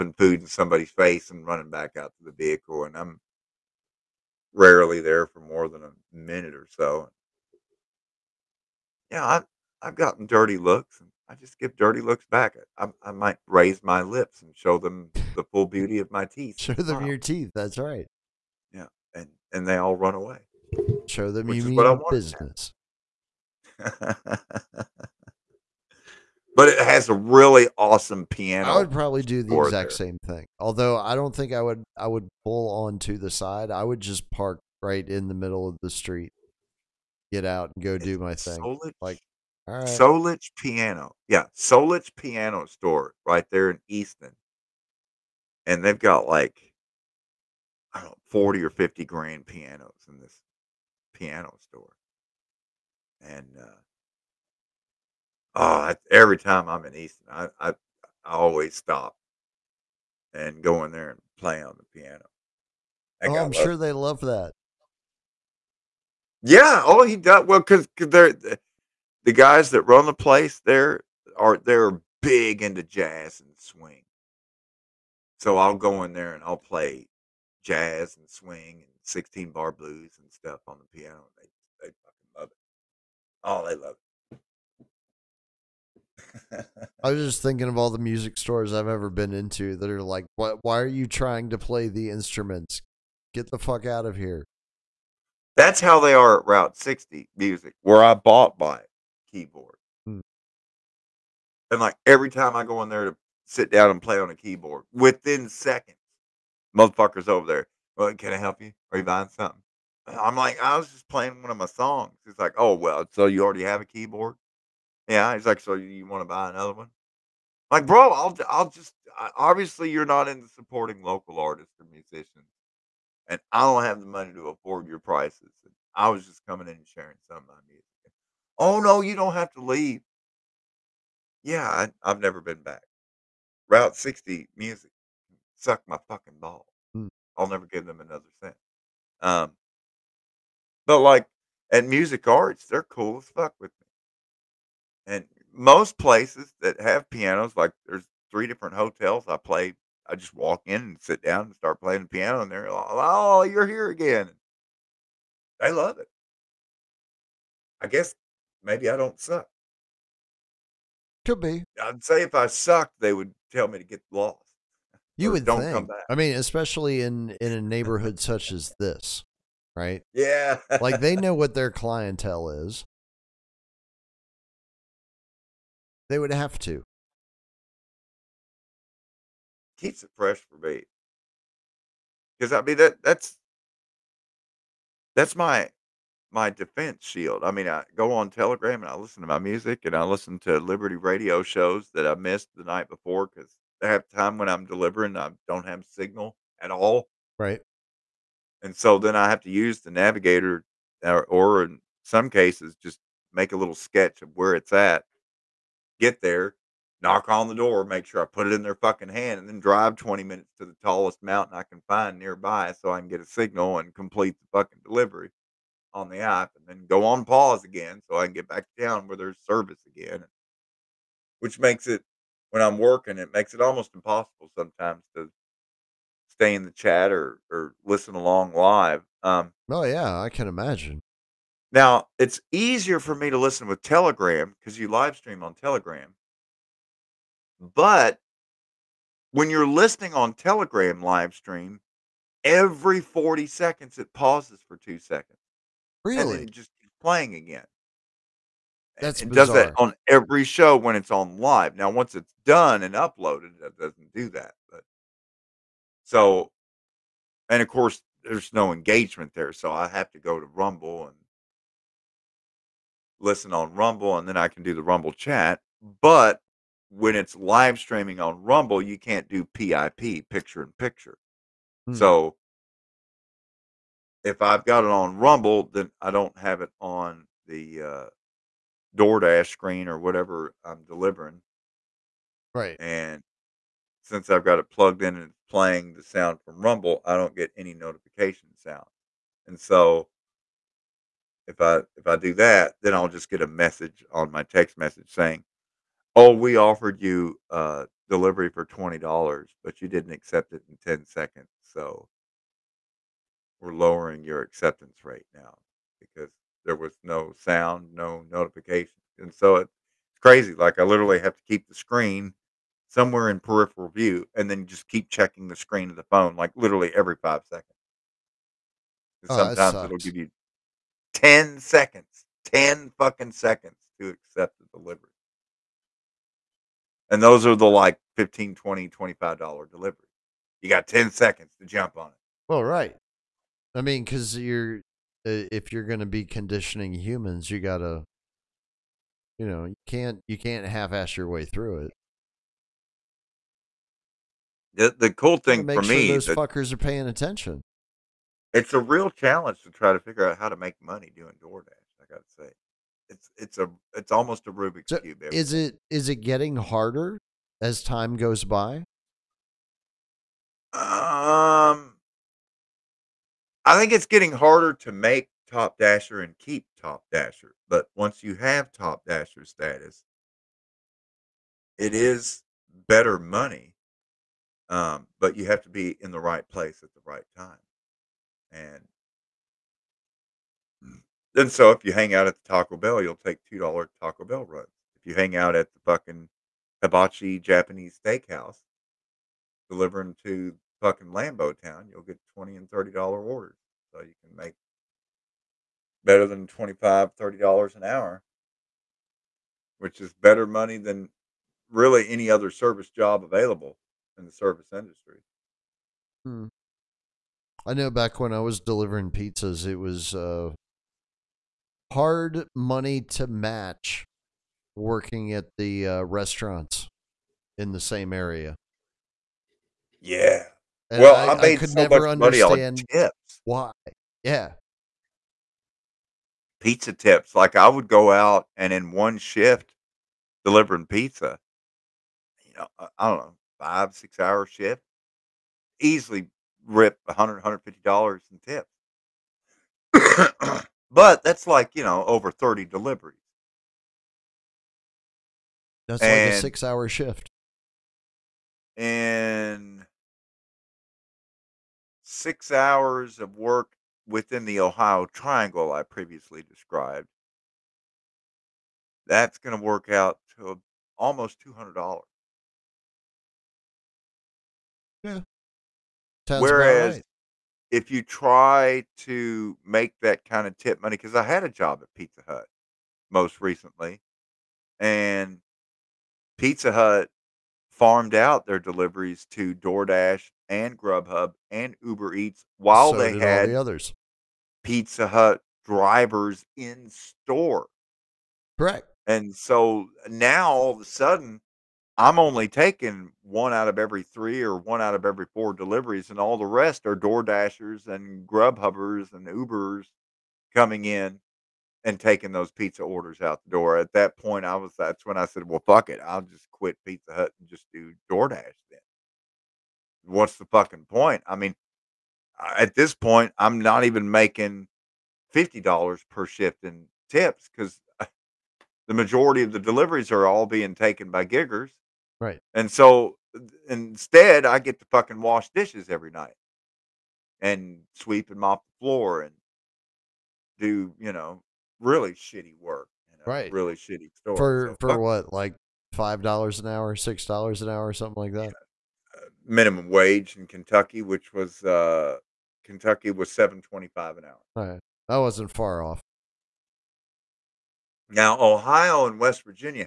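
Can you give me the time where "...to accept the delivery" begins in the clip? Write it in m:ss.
5:24.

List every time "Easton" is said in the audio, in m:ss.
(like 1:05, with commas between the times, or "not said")
0:43, 0:56.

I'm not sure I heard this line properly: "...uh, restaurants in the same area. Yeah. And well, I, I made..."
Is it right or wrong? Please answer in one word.
right.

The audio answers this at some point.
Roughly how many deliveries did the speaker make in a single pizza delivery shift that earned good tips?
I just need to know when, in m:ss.
7:22.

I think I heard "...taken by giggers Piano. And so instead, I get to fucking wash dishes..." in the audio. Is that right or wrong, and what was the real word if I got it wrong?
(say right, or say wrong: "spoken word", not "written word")
wrong: "Right", not "Piano".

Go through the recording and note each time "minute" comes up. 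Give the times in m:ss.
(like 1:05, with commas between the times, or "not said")
0:06, 3:30.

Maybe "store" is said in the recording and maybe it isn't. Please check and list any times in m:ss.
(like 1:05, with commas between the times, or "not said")
0:42, 0:51, 1:28, 8:06, 8:54.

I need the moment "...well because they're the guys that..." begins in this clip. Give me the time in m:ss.
1:07.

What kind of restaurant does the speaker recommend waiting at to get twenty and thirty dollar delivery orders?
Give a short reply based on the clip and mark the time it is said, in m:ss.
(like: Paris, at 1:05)
Hibachi Japanese steakhouse, at 6:26.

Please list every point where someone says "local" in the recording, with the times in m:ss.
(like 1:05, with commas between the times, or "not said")
2:01.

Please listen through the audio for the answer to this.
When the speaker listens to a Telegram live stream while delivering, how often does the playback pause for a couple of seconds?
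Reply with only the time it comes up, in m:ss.
4:03.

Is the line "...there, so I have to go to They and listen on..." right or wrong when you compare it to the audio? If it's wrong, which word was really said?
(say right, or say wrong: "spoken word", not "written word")
wrong: "Rumble", not "They".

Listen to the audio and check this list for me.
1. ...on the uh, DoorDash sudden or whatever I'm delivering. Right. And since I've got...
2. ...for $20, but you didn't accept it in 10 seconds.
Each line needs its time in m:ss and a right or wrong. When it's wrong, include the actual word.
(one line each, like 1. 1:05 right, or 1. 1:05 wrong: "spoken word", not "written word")
1. 4:36 wrong: "screen", not "sudden"
2. 4:58 right.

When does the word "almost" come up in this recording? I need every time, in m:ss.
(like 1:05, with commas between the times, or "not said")
3:43, 5:54, 7:40.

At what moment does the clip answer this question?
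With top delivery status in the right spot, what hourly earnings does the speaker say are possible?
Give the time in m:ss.
6:36.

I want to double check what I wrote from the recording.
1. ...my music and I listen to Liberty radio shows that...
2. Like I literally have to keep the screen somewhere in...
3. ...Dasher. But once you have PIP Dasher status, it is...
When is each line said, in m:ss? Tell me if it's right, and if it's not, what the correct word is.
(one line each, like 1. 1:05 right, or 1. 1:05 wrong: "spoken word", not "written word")
1. 3:09 right
2. 5:10 right
3. 6:07 wrong: "Top", not "PIP".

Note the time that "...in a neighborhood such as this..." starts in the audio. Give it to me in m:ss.
2:47.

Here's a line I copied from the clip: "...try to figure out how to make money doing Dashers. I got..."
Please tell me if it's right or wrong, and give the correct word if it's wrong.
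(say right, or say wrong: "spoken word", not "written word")
wrong: "DoorDash", not "Dashers".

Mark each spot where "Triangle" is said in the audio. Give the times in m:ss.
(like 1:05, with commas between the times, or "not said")
7:35.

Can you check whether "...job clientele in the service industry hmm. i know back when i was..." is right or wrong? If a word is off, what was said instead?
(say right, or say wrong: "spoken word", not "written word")
wrong: "available", not "clientele".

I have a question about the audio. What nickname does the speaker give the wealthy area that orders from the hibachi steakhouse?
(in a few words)
Lambo Town.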